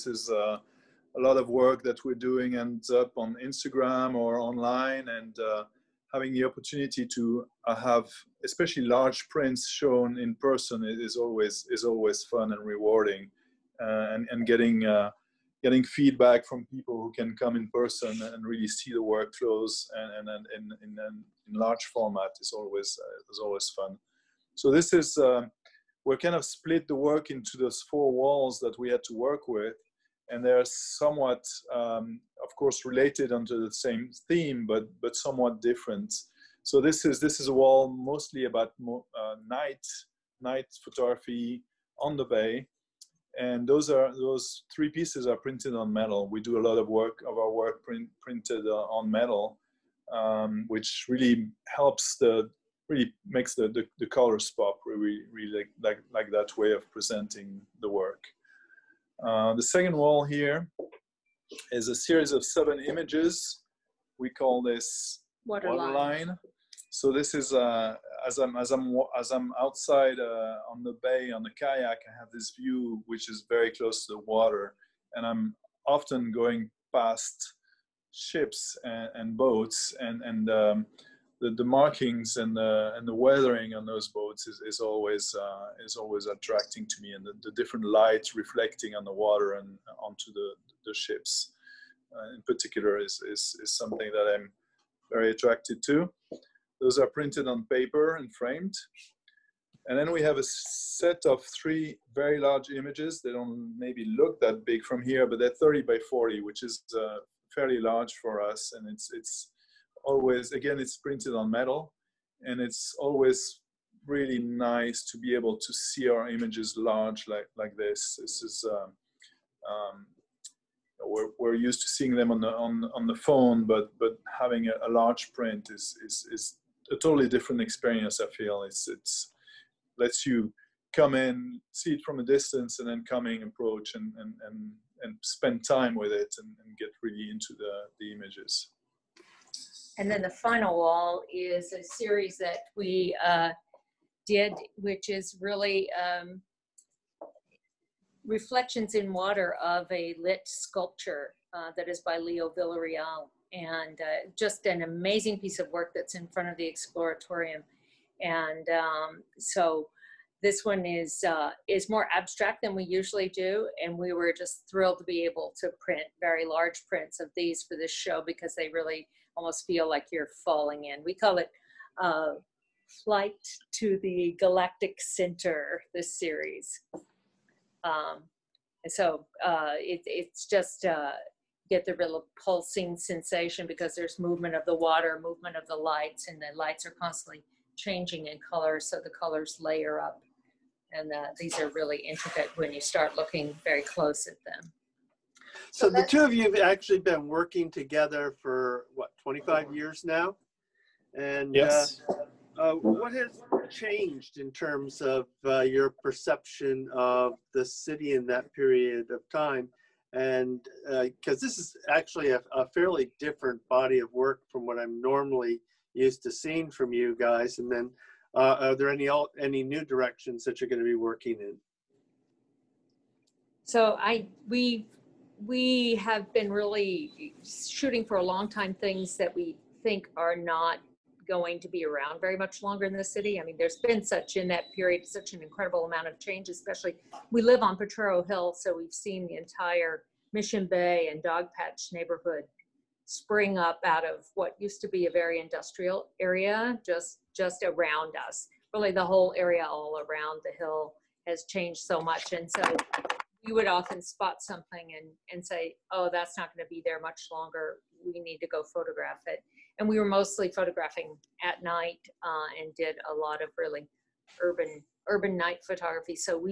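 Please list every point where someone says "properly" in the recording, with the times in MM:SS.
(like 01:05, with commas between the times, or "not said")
not said.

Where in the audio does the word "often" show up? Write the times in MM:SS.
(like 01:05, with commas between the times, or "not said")
01:15, 04:13.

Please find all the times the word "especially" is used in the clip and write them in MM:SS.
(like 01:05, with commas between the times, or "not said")
00:08, 03:56.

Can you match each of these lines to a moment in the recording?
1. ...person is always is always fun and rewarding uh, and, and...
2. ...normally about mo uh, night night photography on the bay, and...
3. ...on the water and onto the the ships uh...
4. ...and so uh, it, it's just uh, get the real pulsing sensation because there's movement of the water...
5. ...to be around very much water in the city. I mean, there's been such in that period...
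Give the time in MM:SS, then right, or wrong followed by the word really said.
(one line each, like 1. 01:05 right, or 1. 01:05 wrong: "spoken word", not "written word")
1. 00:10 right
2. 00:37 wrong: "mostly", not "normally"
3. 01:28 right
4. 02:58 right
5. 03:51 wrong: "longer", not "water".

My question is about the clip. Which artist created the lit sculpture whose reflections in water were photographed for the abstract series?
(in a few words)
Leo Villarreal.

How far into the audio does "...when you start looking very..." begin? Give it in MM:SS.
03:12.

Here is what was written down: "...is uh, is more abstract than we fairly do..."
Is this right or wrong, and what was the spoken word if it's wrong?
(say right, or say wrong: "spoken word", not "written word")
wrong: "usually", not "fairly".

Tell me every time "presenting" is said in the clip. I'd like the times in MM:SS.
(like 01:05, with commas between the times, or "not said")
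00:56.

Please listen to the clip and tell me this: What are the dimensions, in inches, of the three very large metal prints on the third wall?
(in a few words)
30 by 40.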